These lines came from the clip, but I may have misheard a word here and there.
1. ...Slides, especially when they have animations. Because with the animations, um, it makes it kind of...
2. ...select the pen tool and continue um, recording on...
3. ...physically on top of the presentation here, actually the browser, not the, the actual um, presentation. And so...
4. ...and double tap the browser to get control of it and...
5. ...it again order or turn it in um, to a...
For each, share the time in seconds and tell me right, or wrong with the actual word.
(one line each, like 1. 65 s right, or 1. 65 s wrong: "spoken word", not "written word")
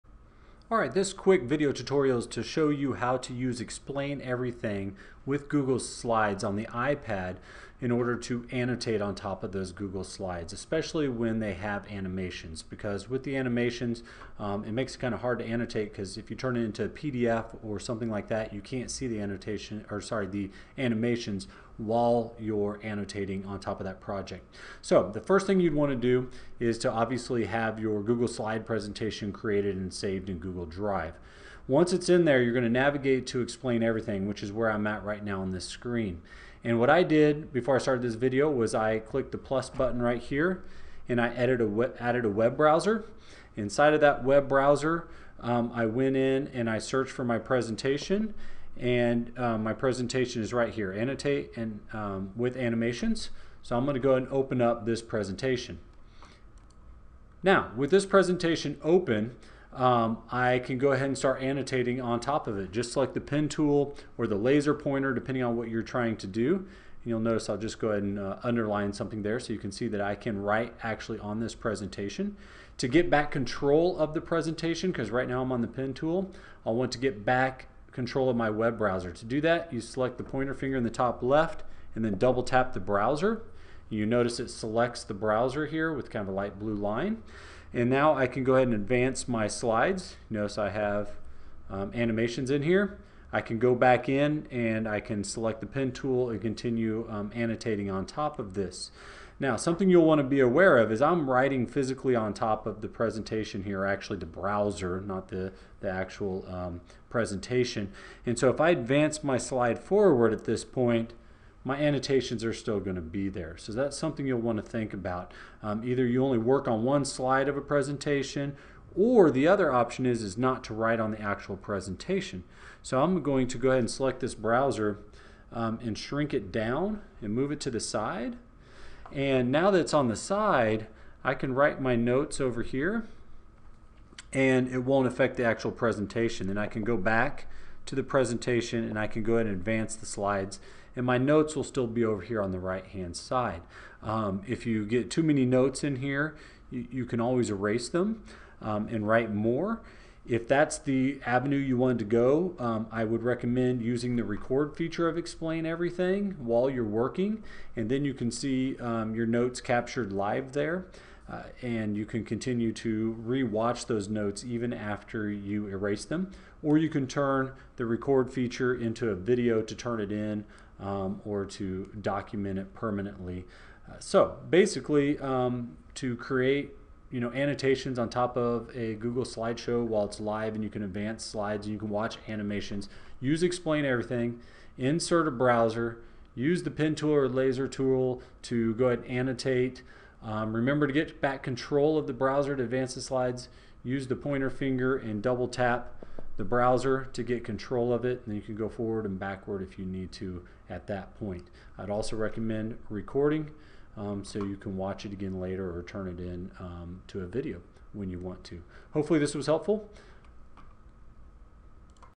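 1. 10 s right
2. 95 s wrong: "annotating", not "recording"
3. 101 s right
4. 194 s right
5. 205 s wrong: "later", not "order".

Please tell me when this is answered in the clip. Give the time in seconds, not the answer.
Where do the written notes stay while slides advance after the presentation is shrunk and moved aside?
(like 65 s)
142 s.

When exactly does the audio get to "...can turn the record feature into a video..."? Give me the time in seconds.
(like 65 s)
166 s.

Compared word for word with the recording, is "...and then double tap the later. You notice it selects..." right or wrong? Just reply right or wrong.
wrong.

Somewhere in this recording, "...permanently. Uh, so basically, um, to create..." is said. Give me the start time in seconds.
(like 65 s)
172 s.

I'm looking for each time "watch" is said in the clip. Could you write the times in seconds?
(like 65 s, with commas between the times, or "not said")
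163 s, 181 s, 204 s.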